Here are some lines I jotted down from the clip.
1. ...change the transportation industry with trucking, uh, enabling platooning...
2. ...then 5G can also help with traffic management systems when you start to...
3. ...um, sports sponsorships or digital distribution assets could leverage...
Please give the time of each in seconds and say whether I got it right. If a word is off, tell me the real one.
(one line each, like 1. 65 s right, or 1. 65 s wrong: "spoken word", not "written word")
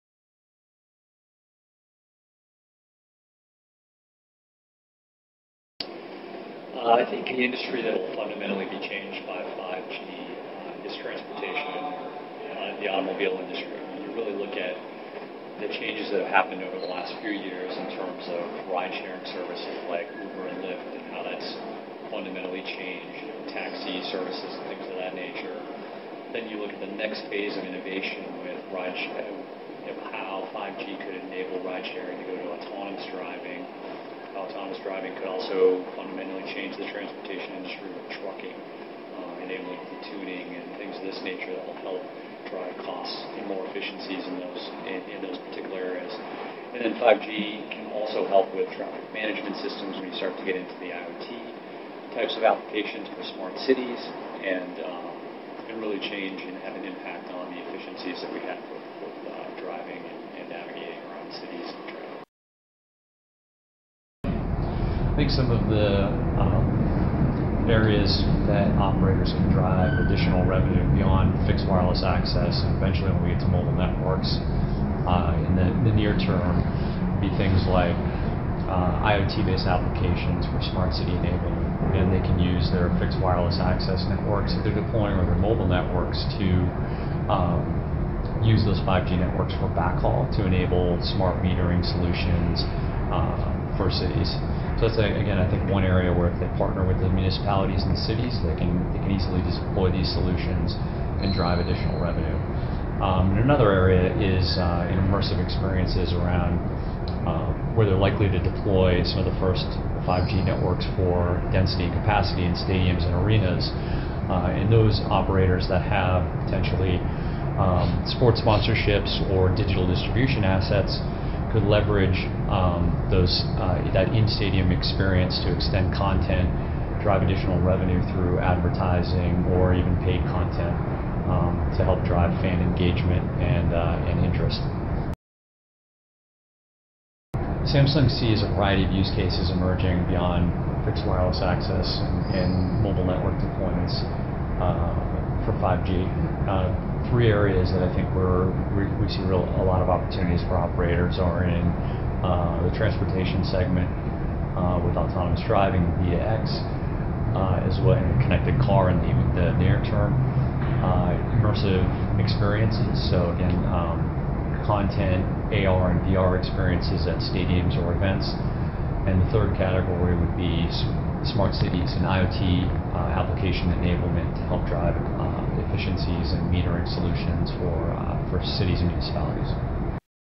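1. 36 s right
2. 46 s right
3. 117 s right.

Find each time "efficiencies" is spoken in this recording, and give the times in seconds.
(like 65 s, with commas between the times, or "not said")
43 s, 57 s, 175 s.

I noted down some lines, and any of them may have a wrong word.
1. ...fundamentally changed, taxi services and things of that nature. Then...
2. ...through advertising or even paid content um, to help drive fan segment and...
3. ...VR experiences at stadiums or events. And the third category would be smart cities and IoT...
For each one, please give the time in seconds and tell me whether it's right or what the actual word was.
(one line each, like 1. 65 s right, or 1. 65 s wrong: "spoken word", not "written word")
1. 22 s right
2. 128 s wrong: "engagement", not "segment"
3. 166 s right.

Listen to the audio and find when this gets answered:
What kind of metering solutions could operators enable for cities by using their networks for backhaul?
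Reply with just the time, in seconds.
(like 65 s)
91 s.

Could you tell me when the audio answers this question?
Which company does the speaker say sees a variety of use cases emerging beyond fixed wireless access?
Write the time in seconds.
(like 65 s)
137 s.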